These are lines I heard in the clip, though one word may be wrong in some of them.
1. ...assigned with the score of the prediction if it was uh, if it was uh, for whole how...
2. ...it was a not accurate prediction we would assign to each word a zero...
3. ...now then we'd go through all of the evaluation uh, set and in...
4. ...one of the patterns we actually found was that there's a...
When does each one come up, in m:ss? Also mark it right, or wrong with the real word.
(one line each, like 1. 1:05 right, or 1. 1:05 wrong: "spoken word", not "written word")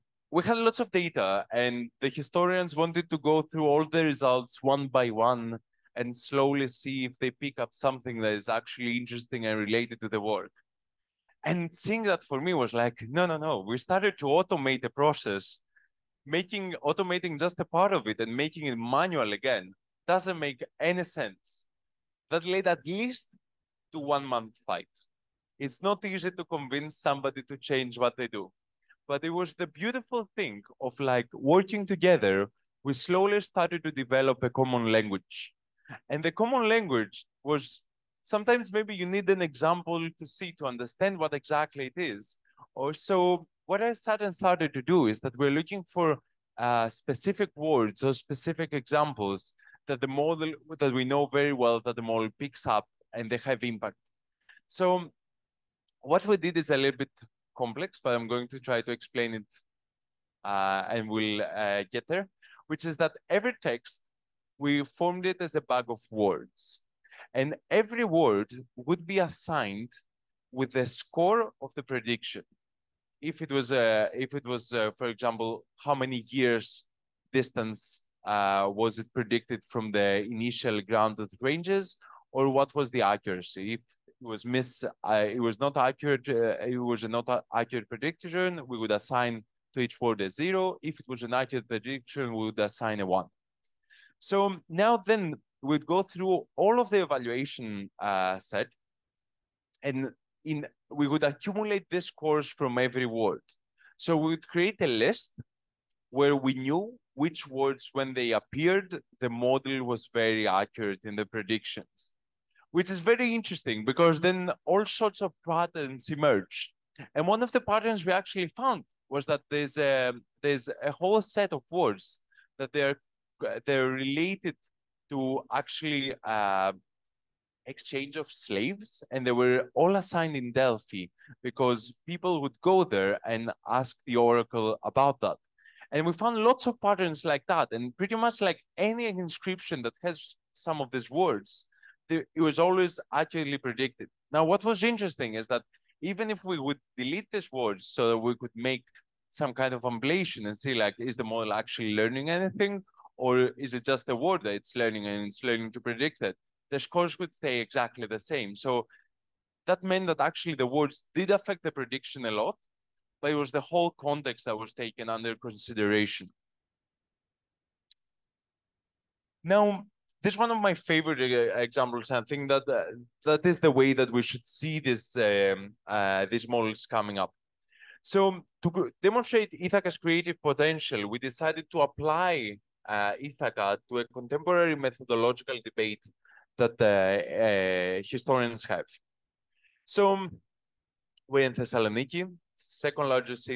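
1. 1:09 wrong: "example", not "whole"
2. 1:26 right
3. 1:34 right
4. 1:57 right.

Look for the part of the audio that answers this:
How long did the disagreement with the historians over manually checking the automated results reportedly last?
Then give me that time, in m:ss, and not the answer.
0:23.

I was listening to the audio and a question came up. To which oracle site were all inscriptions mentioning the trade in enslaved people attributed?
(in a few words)
Delphi.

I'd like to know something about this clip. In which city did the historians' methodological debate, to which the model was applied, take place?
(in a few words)
Thessaloniki.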